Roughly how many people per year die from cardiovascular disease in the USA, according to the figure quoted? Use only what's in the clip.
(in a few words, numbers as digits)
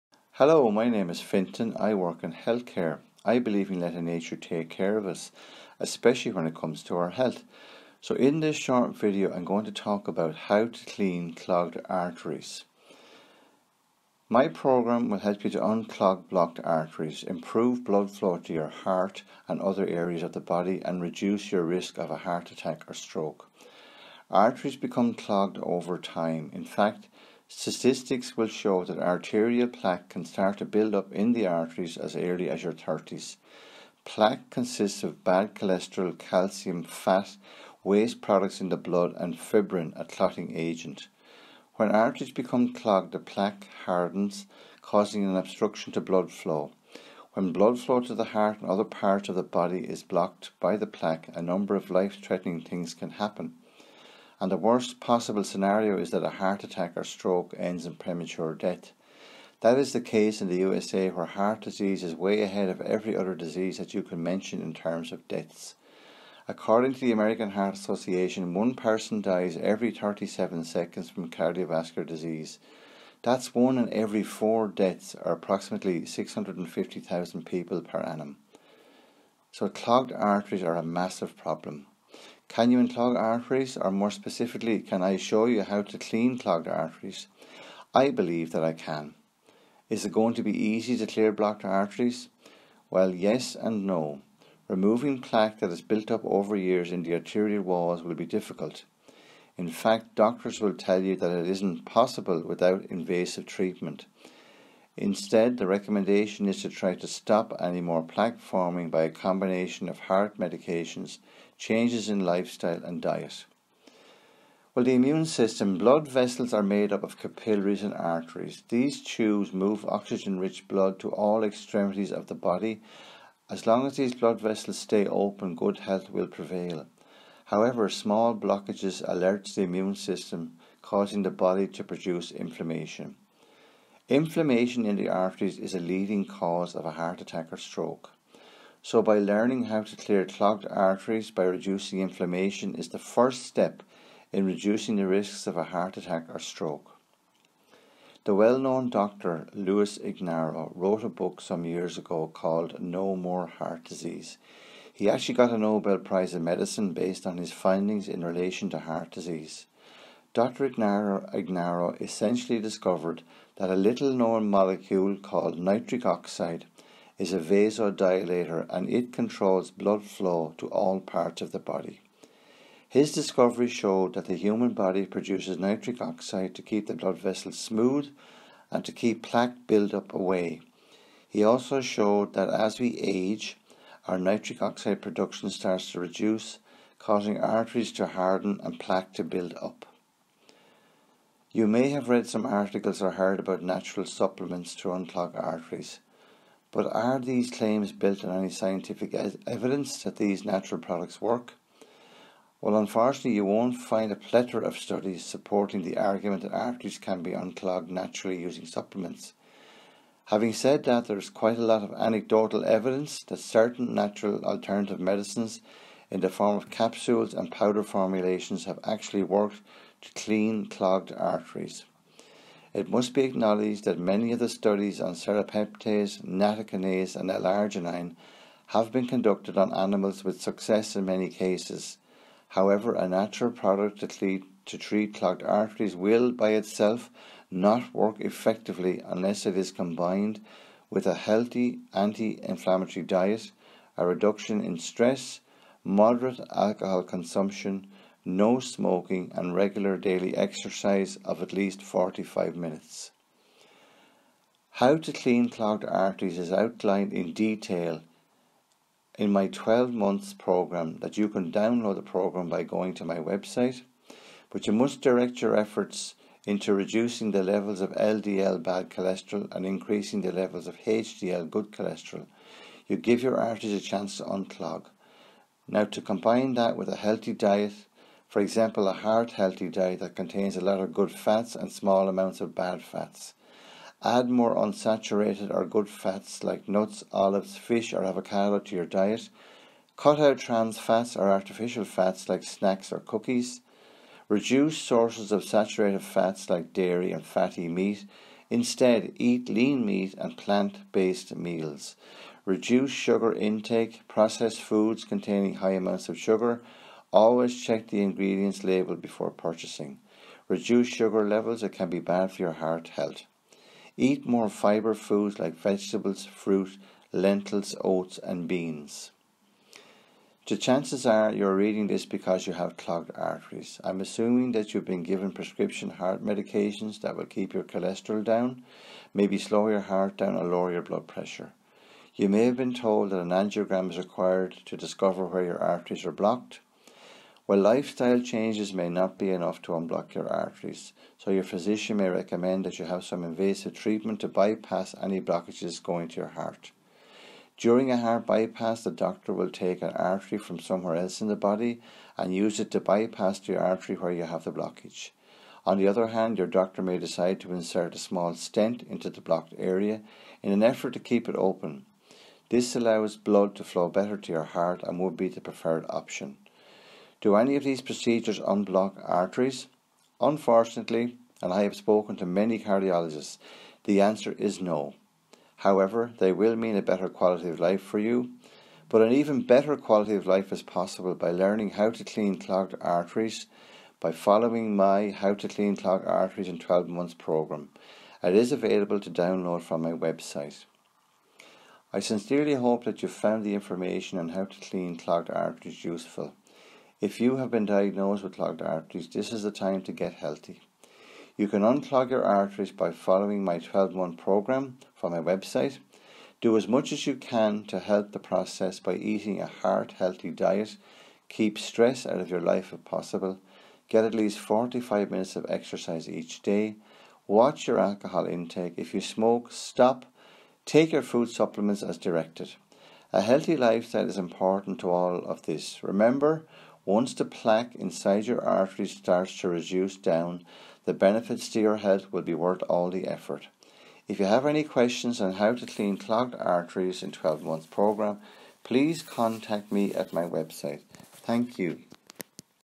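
650,000.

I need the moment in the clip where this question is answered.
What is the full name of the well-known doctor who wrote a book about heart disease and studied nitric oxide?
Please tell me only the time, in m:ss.
2:29.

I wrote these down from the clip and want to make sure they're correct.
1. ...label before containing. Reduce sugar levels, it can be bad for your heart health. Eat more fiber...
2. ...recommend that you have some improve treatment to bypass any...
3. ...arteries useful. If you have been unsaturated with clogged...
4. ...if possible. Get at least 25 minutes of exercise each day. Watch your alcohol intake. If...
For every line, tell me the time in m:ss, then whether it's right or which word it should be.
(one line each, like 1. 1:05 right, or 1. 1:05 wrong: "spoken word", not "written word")
1. 5:08 wrong: "purchasing", not "containing"
2. 5:42 wrong: "invasive", not "improve"
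3. 6:35 wrong: "diagnosed", not "unsaturated"
4. 6:52 wrong: "45", not "25".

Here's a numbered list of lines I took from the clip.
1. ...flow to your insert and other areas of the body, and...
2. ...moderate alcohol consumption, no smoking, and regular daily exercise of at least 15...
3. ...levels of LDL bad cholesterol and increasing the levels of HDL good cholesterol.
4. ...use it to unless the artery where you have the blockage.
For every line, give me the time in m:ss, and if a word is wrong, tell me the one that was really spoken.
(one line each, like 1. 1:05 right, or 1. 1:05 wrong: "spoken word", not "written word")
1. 0:18 wrong: "heart", not "insert"
2. 4:05 wrong: "45", not "15"
3. 4:27 right
4. 5:52 wrong: "bypass", not "unless".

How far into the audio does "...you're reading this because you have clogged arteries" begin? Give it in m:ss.
5:21.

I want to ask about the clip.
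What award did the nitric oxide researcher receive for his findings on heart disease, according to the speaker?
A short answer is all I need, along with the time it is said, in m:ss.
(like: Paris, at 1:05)
Nobel Prize in Medicine, at 2:35.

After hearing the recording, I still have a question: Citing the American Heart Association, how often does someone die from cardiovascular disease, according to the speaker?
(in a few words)
Every 37 seconds.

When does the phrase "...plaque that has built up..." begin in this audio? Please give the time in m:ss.
1:35.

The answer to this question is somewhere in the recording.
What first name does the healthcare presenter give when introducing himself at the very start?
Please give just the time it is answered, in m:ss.
0:01.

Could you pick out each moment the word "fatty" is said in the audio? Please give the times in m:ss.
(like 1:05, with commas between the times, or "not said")
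4:57.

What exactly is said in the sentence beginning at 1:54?
Well, the immune system, blood vessels are made up of capillaries and arteries.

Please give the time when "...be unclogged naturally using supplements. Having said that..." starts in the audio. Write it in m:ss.
3:27.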